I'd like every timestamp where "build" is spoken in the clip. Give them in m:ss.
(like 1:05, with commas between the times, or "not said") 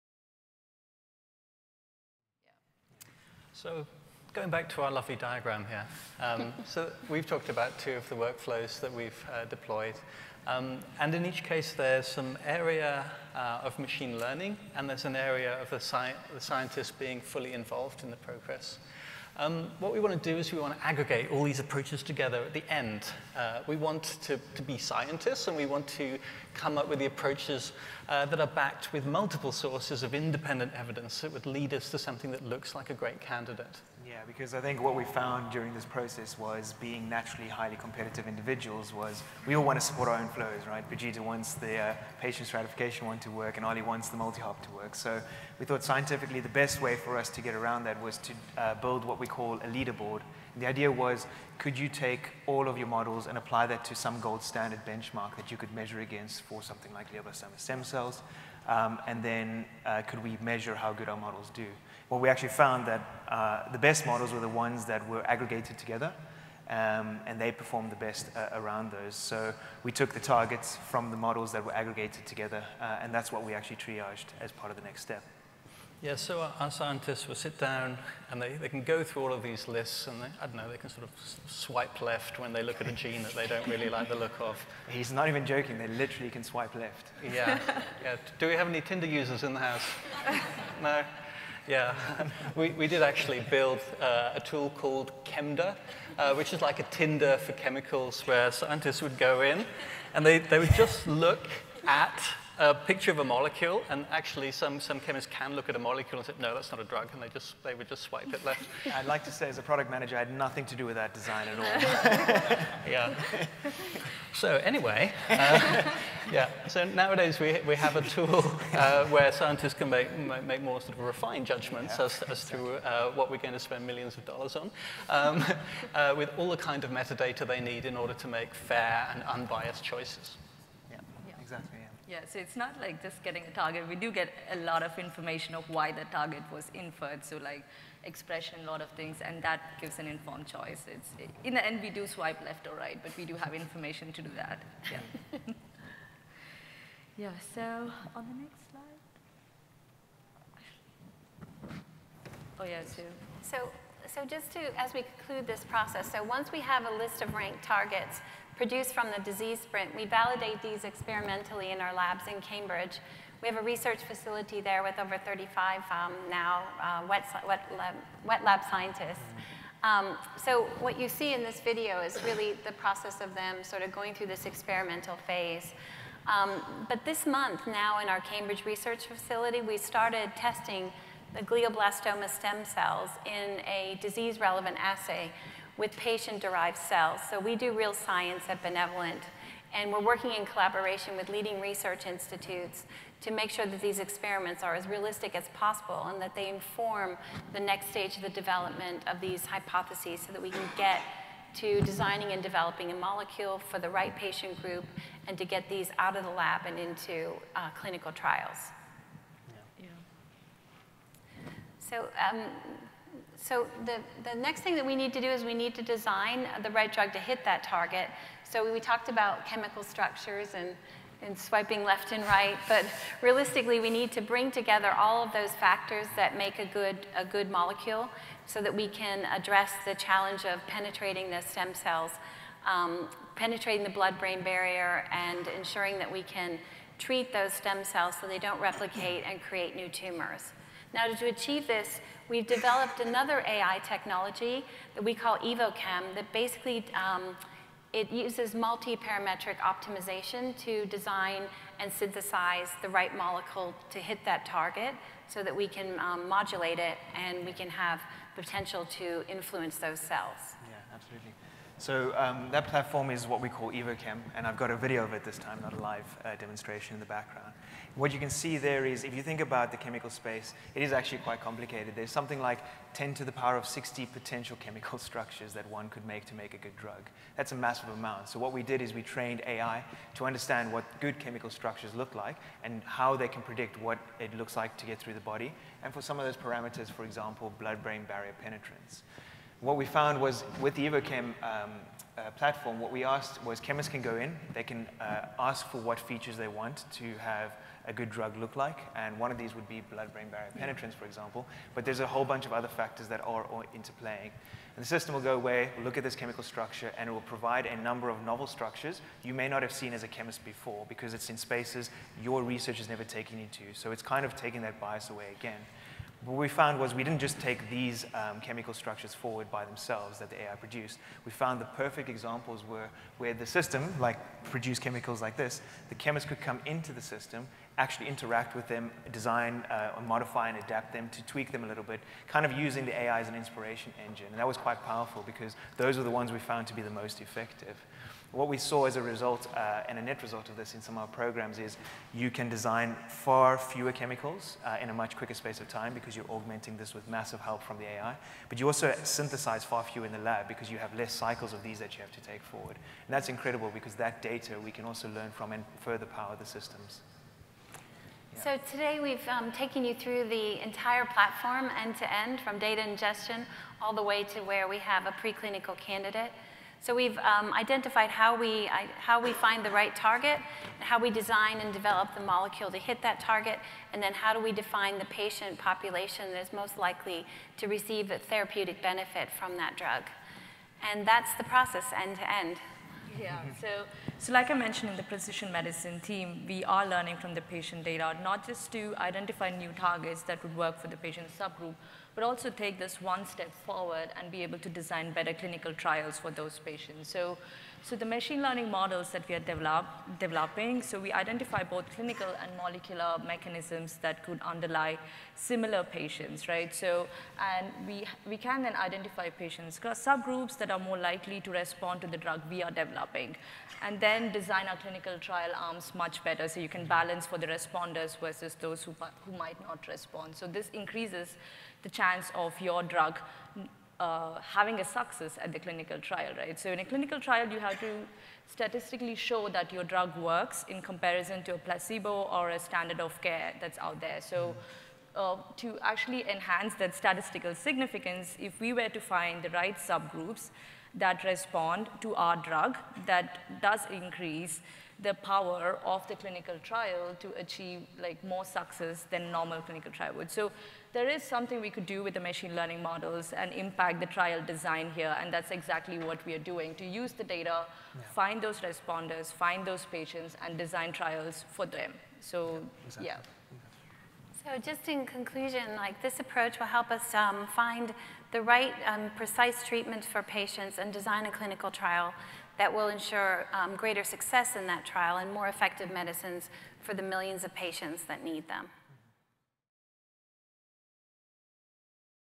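0:48, 1:33.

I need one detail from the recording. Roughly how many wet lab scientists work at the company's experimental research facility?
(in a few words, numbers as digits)
over 35.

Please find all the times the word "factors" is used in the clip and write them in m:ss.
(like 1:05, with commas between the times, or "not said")
3:45, 5:02.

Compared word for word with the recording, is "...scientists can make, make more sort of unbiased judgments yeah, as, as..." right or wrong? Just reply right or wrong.
wrong.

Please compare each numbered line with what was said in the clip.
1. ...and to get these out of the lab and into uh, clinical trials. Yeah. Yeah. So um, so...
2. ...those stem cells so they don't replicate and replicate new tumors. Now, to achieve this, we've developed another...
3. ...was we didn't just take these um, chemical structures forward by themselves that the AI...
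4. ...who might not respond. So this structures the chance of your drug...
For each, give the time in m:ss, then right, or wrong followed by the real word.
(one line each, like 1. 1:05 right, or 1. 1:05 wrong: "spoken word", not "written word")
1. 3:25 right
2. 3:57 wrong: "create", not "replicate"
3. 5:16 right
4. 6:59 wrong: "increases", not "structures".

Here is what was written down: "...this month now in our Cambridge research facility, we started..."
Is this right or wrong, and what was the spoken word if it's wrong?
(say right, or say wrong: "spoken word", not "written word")
right.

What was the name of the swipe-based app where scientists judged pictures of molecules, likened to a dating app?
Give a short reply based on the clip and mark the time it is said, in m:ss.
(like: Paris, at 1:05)
Chemda, at 1:35.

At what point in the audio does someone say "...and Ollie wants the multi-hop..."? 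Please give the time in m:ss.
0:43.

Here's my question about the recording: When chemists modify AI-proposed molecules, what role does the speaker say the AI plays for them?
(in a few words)
inspiration engine.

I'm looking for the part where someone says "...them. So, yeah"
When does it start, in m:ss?
7:41.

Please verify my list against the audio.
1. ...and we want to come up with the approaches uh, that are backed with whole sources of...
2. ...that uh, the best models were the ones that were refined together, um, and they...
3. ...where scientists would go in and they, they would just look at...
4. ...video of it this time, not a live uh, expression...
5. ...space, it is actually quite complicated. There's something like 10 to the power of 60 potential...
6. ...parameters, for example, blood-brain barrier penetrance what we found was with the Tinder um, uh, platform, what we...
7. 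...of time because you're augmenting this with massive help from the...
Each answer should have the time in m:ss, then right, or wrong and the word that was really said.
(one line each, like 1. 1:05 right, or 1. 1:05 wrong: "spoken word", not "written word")
1. 0:25 wrong: "multiple", not "whole"
2. 1:02 wrong: "aggregated", not "refined"
3. 1:38 right
4. 4:24 wrong: "demonstration", not "expression"
5. 4:30 right
6. 4:46 wrong: "EvoChem", not "Tinder"
7. 5:45 right.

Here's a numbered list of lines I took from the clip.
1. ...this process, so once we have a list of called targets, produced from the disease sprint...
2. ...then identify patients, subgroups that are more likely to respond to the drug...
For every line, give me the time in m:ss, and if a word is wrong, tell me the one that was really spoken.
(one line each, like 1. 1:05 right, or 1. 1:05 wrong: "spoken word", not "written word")
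1. 2:35 wrong: "ranked", not "called"
2. 6:48 right.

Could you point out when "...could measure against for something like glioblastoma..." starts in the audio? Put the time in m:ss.
0:55.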